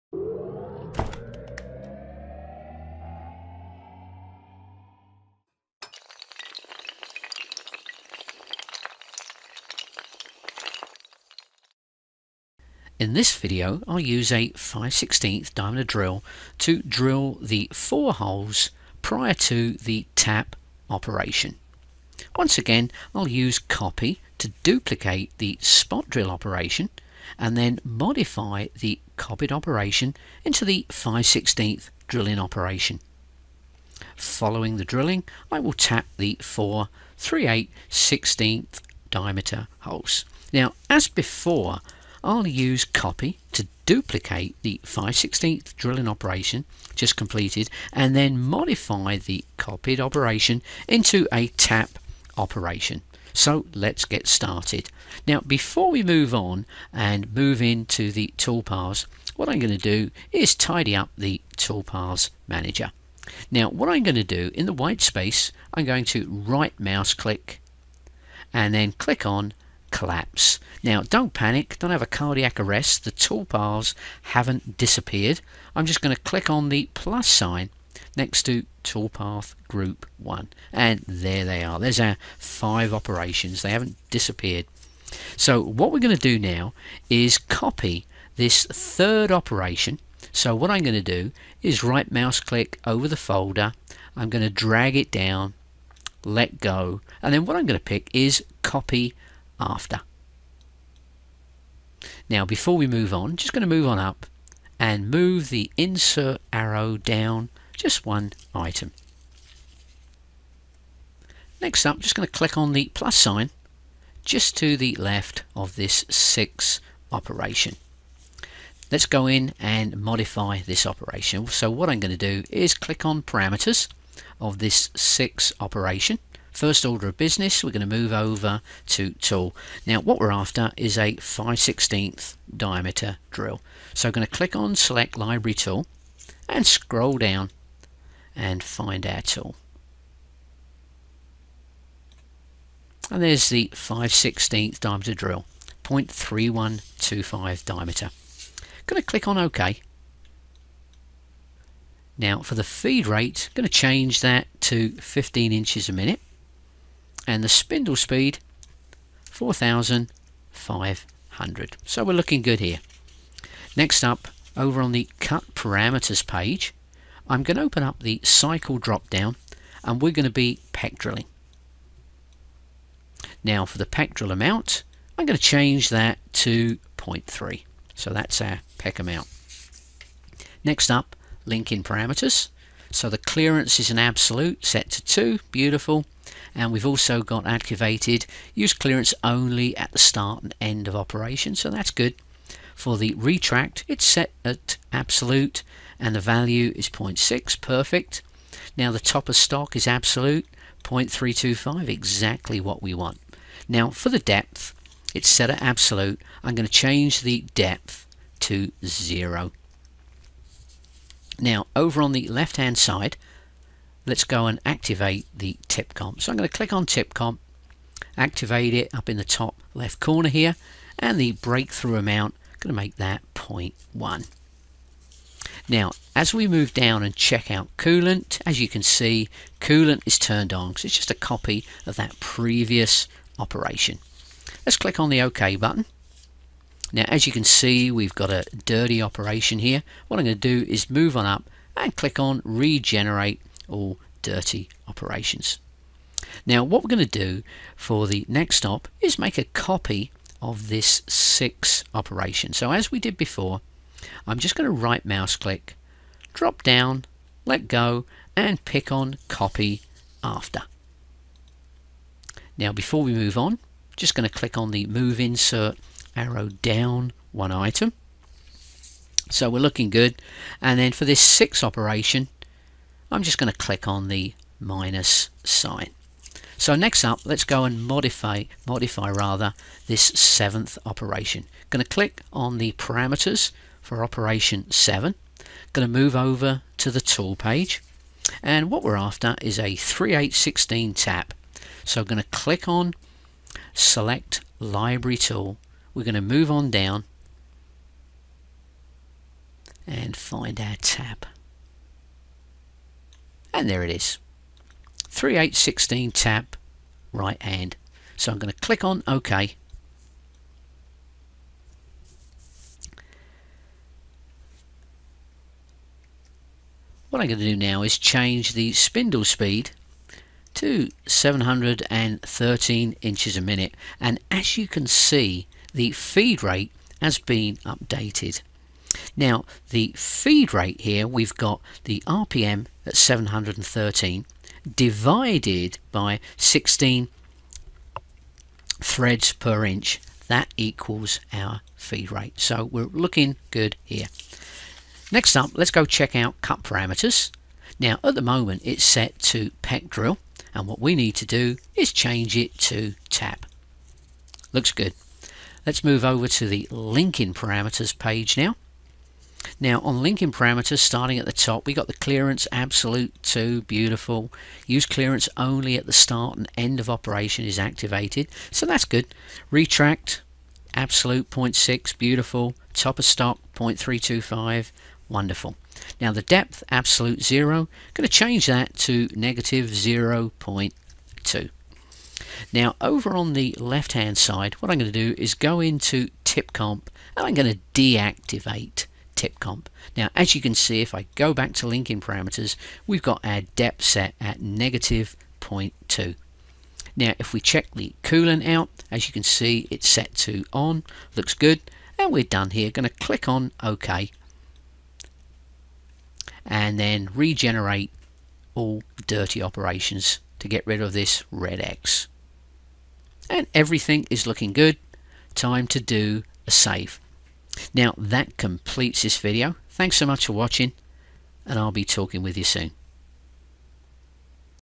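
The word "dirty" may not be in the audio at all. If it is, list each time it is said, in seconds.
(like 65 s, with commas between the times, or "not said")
238 s, 244 s, 409 s.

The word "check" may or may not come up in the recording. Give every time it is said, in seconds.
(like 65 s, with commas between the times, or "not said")
227 s, 345 s, 397 s.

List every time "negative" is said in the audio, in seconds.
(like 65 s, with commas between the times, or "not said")
379 s, 394 s.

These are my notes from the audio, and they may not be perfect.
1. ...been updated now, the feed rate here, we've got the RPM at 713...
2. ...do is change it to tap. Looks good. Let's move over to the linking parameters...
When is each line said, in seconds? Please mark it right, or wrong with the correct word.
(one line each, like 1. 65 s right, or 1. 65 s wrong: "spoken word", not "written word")
1. 327 s right
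2. 351 s right.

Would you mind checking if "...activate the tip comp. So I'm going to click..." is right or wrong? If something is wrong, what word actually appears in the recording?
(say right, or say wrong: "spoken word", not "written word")
right.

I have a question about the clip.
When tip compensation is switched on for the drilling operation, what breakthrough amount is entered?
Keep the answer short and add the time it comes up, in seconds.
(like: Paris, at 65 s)
0.1, at 223 s.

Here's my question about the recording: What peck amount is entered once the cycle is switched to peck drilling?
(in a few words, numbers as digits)
0.3.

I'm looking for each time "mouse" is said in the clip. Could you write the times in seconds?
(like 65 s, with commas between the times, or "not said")
66 s, 92 s, 255 s.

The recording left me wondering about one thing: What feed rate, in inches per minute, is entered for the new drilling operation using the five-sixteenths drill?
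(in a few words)
15.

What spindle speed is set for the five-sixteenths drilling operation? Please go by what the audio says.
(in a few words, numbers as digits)
4500.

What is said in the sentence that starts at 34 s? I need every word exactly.
Following the drilling I will tap the four 3 8 16th diameter holes.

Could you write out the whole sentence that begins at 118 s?
Let's go in and modify this operation.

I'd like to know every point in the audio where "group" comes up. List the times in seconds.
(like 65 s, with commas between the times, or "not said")
79 s.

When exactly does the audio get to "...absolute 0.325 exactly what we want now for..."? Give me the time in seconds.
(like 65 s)
199 s.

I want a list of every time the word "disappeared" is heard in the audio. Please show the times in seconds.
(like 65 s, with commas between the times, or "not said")
74 s, 84 s.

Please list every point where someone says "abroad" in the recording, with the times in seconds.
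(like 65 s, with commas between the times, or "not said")
not said.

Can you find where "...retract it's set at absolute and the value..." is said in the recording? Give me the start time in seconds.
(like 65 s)
193 s.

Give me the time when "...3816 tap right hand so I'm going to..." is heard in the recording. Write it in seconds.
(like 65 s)
305 s.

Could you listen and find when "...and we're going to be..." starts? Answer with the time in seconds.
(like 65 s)
169 s.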